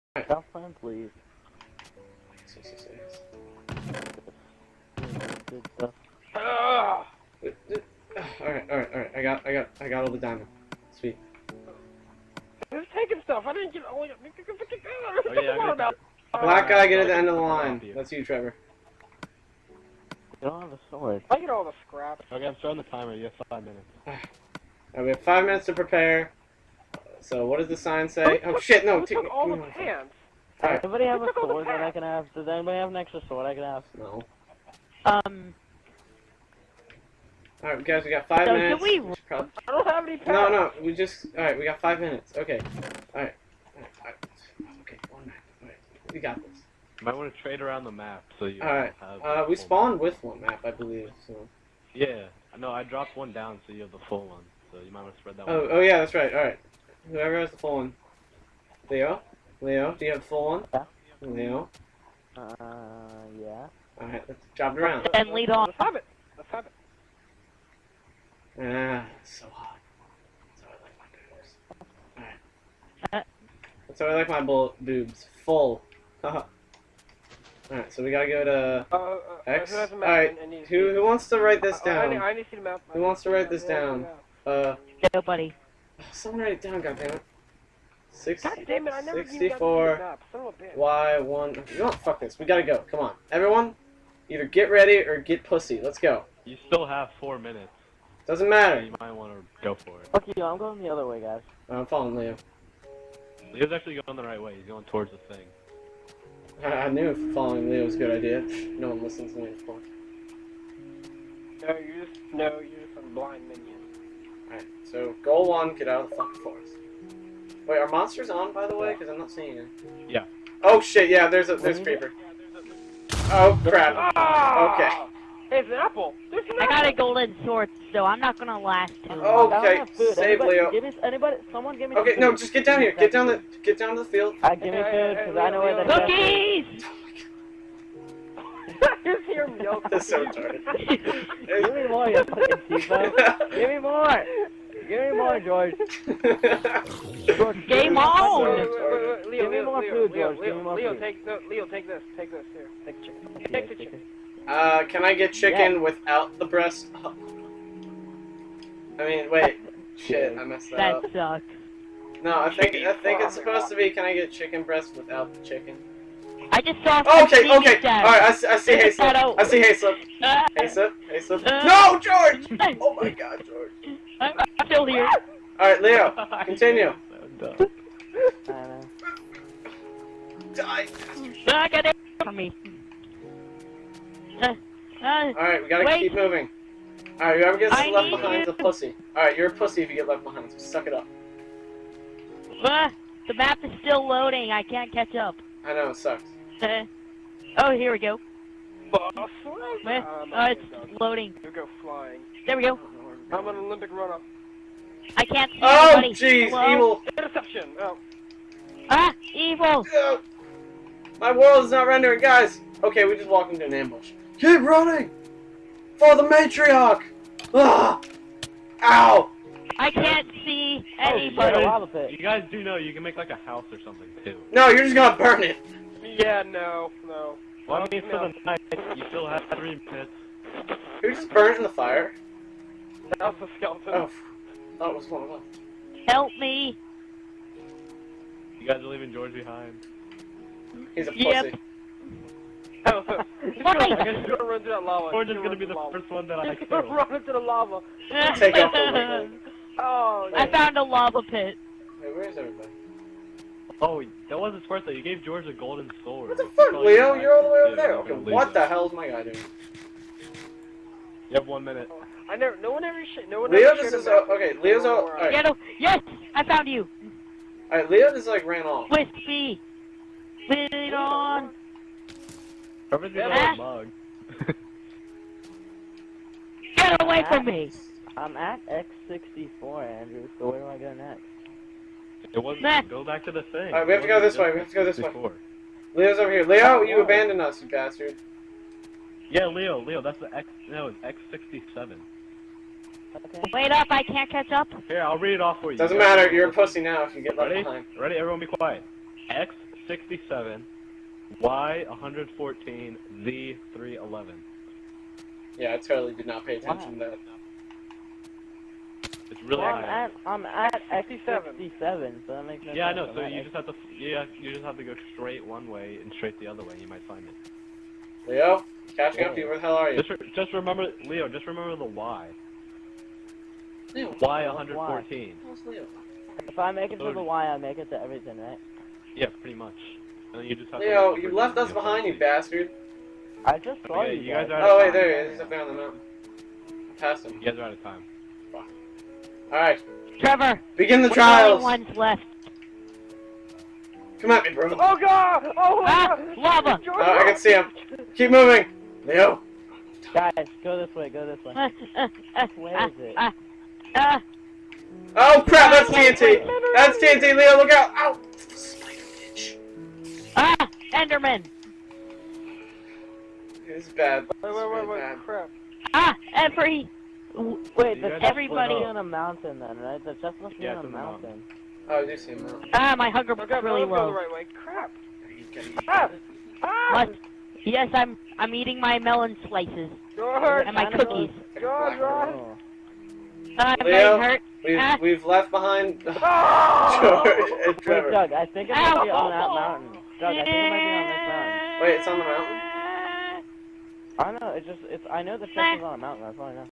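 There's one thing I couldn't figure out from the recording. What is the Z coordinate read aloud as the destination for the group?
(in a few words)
311.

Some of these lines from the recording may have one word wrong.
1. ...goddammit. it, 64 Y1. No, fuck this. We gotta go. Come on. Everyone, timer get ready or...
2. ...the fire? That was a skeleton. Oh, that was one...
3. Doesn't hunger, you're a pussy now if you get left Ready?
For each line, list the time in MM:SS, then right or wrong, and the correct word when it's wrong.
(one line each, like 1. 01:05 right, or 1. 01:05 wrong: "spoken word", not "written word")
1. 01:26 wrong: "either", not "timer"
2. 03:51 right
3. 04:55 wrong: "matter", not "hunger".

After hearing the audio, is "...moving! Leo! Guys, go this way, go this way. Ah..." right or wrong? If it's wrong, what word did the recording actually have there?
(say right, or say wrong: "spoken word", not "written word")
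right.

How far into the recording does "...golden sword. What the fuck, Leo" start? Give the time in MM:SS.
04:15.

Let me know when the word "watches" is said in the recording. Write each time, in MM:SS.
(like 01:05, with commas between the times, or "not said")
not said.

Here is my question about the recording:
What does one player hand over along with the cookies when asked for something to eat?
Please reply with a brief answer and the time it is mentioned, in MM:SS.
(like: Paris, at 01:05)
milk, at 02:19.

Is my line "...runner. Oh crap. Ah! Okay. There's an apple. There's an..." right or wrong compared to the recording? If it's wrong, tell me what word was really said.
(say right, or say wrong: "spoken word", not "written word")
wrong: "creeper", not "runner".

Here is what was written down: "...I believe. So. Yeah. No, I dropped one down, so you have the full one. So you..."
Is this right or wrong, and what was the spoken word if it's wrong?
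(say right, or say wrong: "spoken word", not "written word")
right.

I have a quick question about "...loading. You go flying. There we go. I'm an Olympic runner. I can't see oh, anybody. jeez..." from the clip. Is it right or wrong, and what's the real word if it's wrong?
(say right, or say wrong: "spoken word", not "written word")
right.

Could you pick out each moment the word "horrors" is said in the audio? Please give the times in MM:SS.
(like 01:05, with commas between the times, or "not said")
not said.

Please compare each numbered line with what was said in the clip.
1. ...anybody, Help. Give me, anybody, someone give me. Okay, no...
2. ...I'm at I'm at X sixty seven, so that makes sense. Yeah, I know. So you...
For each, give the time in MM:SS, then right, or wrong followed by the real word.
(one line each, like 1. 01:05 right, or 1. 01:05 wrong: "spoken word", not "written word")
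1. 02:10 wrong: "Leo", not "Help"
2. 05:09 right.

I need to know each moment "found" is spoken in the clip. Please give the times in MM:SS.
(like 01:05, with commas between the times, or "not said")
04:10, 04:26.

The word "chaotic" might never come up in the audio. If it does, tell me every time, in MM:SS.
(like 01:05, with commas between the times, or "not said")
not said.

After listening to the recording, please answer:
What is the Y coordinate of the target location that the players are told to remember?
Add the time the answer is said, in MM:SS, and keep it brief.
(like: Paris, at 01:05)
114, at 05:01.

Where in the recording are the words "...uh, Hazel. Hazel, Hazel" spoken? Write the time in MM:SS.
02:49.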